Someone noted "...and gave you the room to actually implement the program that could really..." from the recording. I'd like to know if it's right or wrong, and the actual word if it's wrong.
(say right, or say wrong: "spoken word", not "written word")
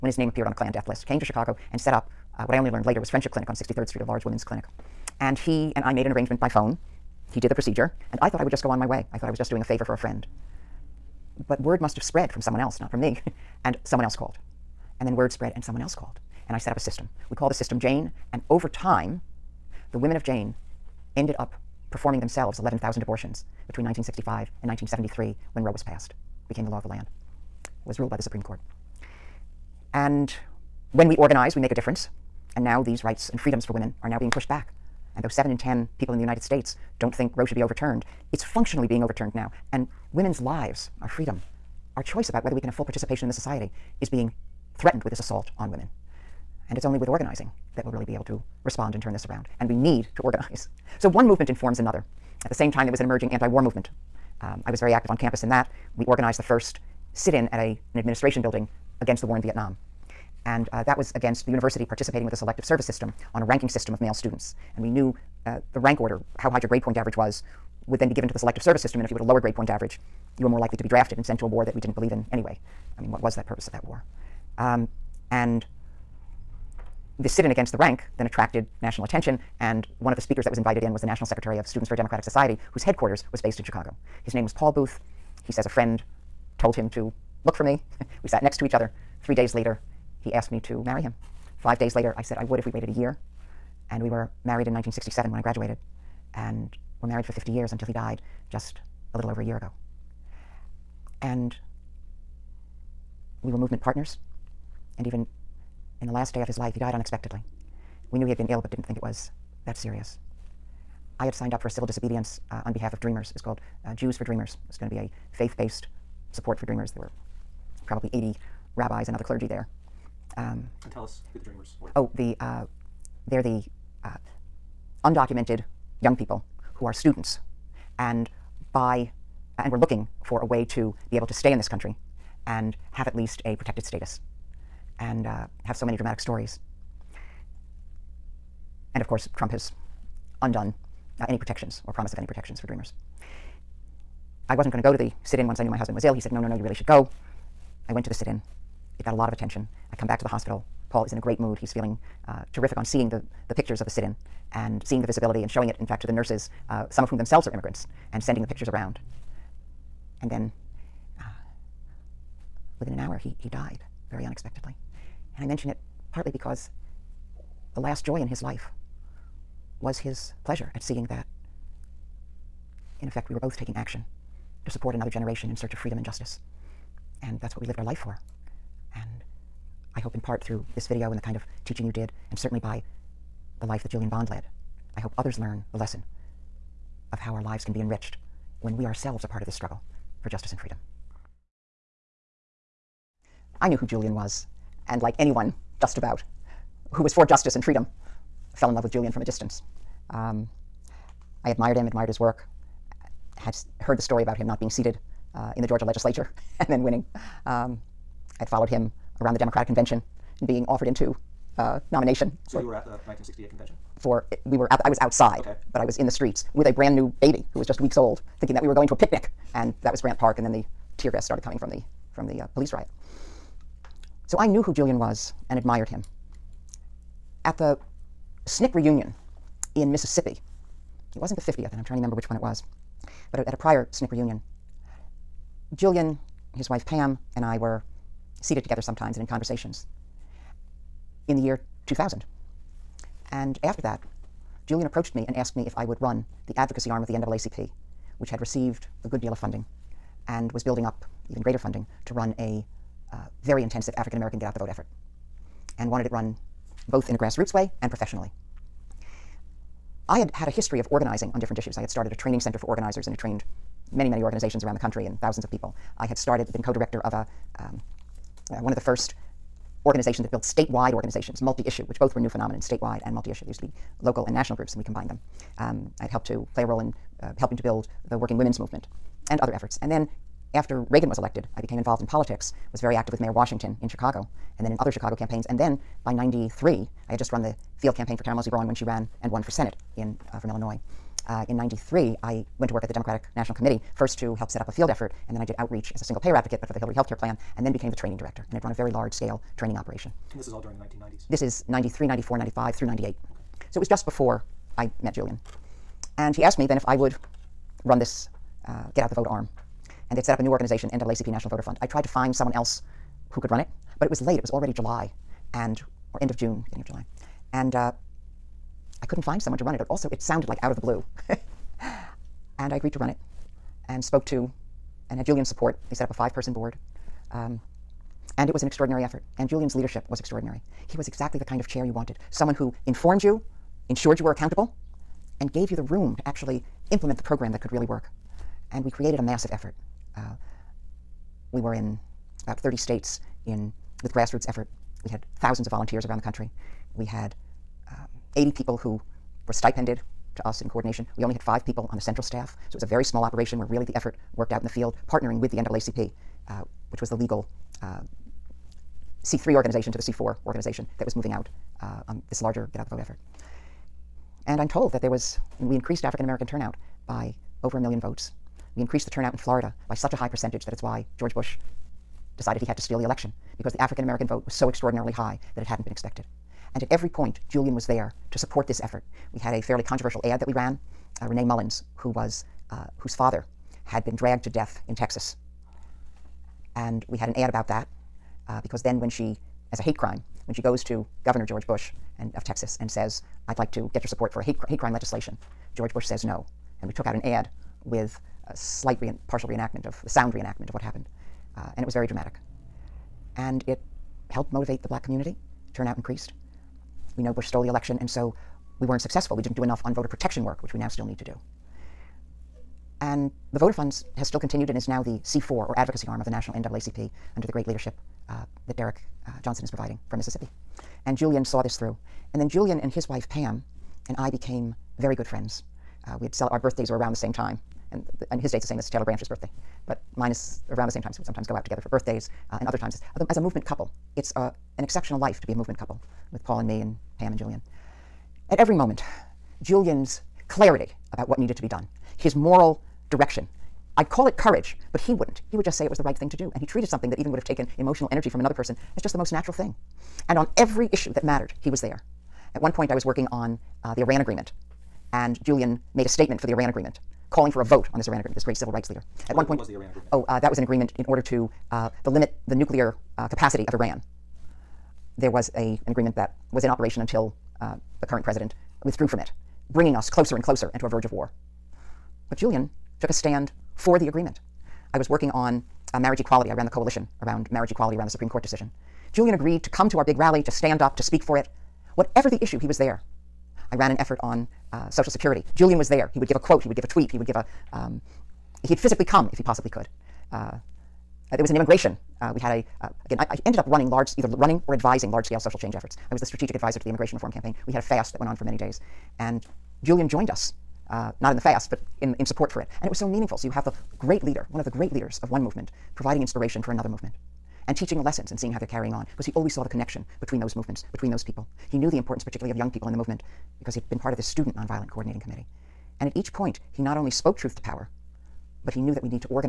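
right.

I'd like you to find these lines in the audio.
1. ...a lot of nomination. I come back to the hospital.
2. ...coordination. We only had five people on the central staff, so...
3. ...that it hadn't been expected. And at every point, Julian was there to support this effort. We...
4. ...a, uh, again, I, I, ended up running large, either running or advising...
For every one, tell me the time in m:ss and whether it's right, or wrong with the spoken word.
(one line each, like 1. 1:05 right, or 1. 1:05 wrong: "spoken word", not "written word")
1. 2:29 wrong: "attention", not "nomination"
2. 5:50 right
3. 6:15 right
4. 8:12 right.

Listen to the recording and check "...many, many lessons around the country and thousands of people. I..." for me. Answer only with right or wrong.
wrong.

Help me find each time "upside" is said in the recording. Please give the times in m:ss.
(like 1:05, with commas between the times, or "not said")
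not said.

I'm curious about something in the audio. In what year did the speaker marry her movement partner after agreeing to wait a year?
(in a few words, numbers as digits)
1967.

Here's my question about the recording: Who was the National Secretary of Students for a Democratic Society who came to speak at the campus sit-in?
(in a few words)
Paul Booth.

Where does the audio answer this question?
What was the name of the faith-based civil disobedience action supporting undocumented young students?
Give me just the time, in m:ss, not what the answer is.
1:53.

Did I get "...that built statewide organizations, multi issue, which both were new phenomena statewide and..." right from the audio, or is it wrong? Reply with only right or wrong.
right.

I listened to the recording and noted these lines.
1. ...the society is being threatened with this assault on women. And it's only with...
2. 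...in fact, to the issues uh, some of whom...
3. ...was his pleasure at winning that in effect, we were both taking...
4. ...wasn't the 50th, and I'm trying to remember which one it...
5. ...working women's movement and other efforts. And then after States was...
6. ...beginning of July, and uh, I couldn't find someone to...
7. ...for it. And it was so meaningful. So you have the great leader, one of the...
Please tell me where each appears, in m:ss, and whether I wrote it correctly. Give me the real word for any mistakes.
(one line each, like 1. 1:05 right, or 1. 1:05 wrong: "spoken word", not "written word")
1. 0:43 right
2. 2:35 wrong: "nurses", not "issues"
3. 2:49 wrong: "seeing", not "winning"
4. 3:51 right
5. 4:38 wrong: "Reagan", not "States"
6. 5:16 right
7. 8:22 right.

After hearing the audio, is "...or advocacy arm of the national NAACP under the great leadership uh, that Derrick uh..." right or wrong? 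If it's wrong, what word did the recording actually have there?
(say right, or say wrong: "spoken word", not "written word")
right.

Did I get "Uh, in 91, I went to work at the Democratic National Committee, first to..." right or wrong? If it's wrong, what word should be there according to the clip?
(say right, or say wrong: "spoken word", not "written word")
wrong: "93", not "91".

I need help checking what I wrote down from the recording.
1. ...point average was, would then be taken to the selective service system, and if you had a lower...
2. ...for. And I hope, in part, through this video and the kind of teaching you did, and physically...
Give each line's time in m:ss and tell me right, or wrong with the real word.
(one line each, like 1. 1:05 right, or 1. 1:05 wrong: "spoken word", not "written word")
1. 1:06 wrong: "given", not "taken"
2. 2:57 wrong: "certainly", not "physically".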